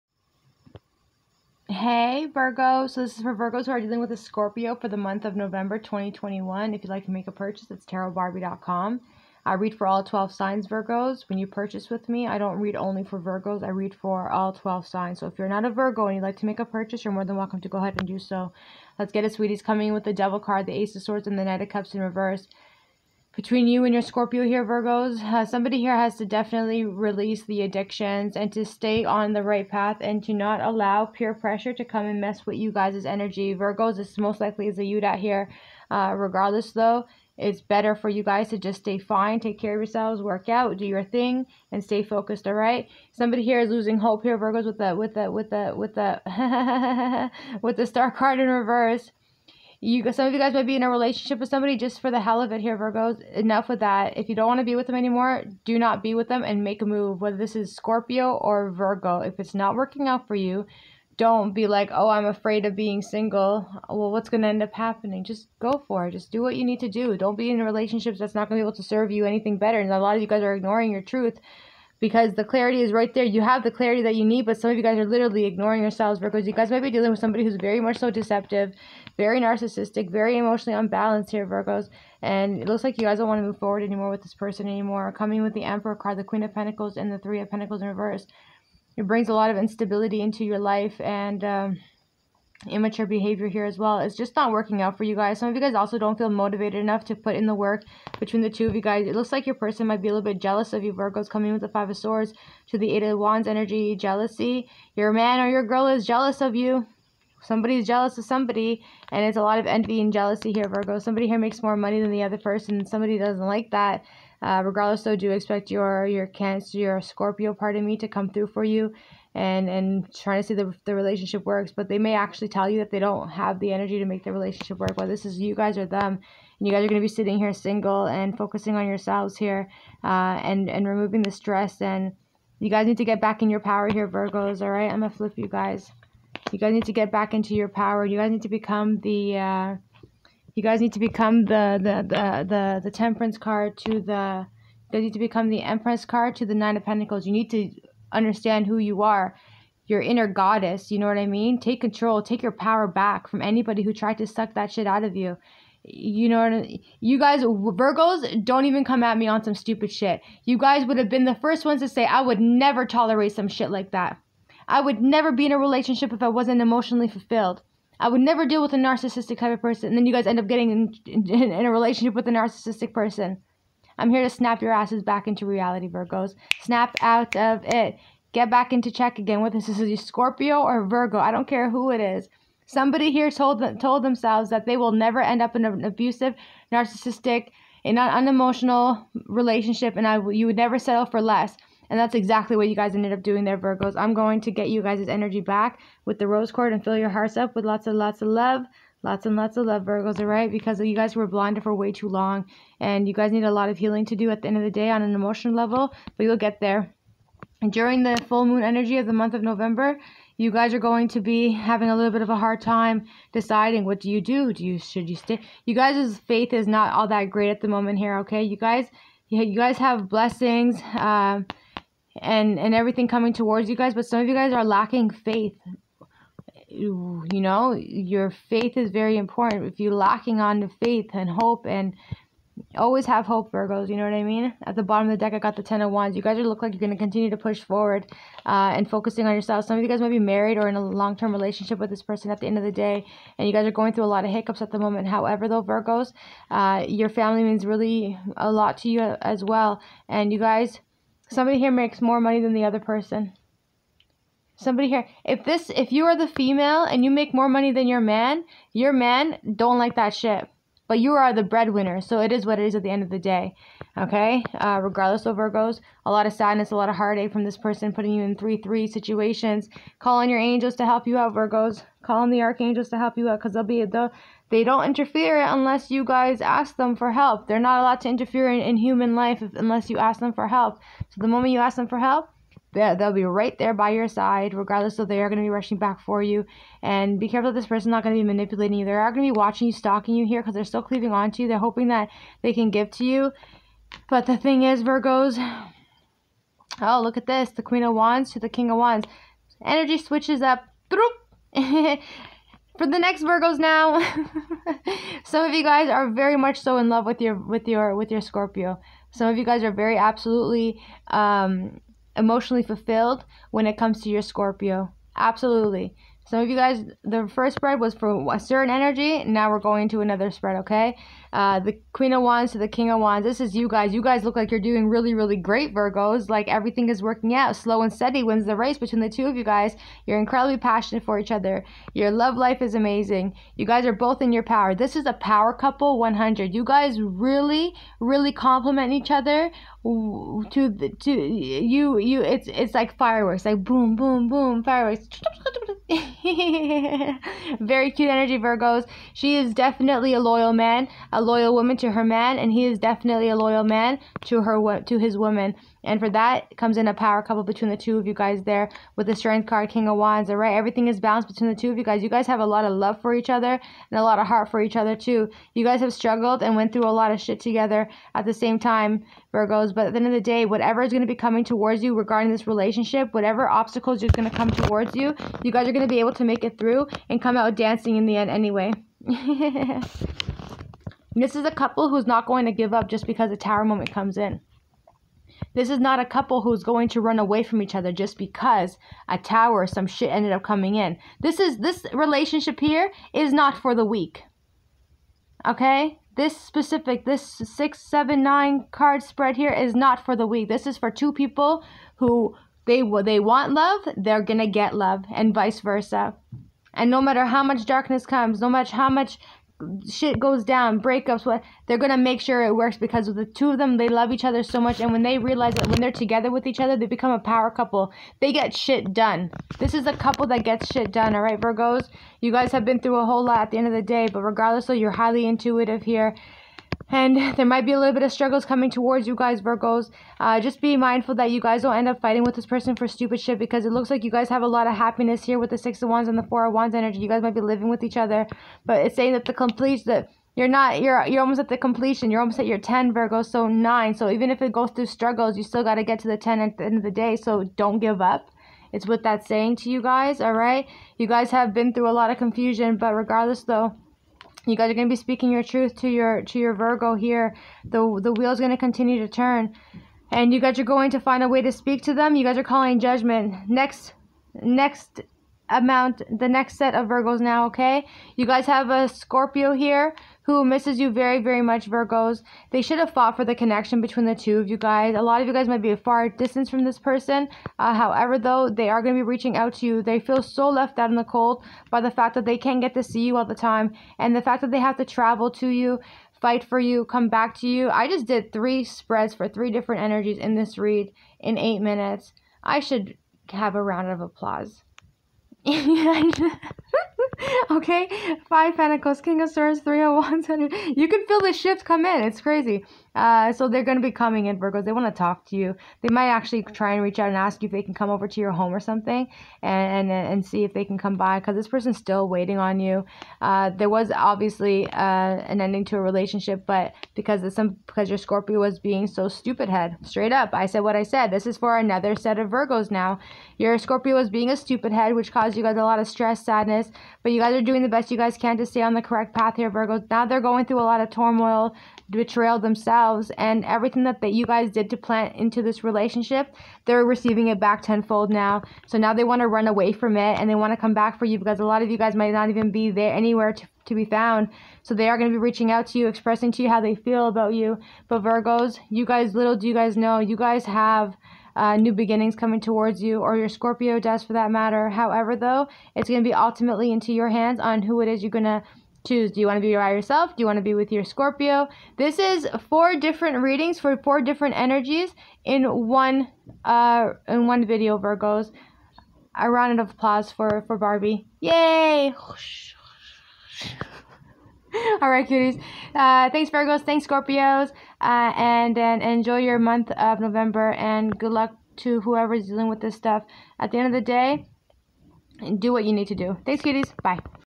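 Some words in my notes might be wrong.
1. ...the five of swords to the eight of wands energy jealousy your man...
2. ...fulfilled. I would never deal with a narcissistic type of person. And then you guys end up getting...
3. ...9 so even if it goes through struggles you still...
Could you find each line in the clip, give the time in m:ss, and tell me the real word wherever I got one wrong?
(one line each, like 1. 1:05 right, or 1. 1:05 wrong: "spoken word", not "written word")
1. 1:41 right
2. 2:47 right
3. 7:23 right.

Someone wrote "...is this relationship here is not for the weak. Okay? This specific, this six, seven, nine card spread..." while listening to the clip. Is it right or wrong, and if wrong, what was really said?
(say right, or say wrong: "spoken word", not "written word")
right.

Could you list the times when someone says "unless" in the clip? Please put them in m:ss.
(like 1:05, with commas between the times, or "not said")
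4:35, 4:39.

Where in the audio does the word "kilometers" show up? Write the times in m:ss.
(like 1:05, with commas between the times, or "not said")
not said.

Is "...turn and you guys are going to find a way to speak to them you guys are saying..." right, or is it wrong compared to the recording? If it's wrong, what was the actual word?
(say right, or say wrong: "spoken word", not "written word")
wrong: "calling", not "saying".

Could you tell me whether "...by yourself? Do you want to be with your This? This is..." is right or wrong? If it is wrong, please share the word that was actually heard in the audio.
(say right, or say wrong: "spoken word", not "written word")
wrong: "Scorpio", not "This".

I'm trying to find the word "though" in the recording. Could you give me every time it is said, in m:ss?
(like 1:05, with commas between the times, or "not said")
0:36, 1:55, 4:05, 7:33, 7:58, 9:15.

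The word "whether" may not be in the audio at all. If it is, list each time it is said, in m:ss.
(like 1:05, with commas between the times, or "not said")
0:57, 2:04.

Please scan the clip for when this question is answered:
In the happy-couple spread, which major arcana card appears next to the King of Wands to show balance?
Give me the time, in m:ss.
5:59.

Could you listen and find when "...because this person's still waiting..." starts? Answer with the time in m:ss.
8:31.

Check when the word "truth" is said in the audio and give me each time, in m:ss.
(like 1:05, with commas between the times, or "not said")
1:11, 7:35.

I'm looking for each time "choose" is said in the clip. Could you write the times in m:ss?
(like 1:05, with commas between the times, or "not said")
9:18.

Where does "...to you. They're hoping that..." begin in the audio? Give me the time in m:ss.
4:51.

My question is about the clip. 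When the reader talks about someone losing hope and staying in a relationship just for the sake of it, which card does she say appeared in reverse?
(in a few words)
The Star.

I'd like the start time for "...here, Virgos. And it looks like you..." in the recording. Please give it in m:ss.
1:21.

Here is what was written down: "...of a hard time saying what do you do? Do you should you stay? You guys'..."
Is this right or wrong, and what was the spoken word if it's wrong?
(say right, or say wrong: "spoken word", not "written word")
wrong: "deciding", not "saying".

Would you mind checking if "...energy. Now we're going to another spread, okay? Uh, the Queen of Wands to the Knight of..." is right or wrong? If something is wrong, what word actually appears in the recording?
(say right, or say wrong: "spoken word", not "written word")
wrong: "King", not "Knight".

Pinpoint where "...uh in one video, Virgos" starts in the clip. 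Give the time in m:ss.
9:26.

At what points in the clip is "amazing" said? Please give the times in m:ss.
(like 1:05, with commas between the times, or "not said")
5:32.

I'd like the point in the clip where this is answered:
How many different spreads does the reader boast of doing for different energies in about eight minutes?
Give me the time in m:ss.
8:08.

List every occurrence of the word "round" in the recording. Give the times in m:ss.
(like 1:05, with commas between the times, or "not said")
8:13, 9:29.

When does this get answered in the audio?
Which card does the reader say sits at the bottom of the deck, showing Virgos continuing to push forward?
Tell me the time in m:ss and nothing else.
3:55.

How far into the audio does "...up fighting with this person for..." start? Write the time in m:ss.
7:11.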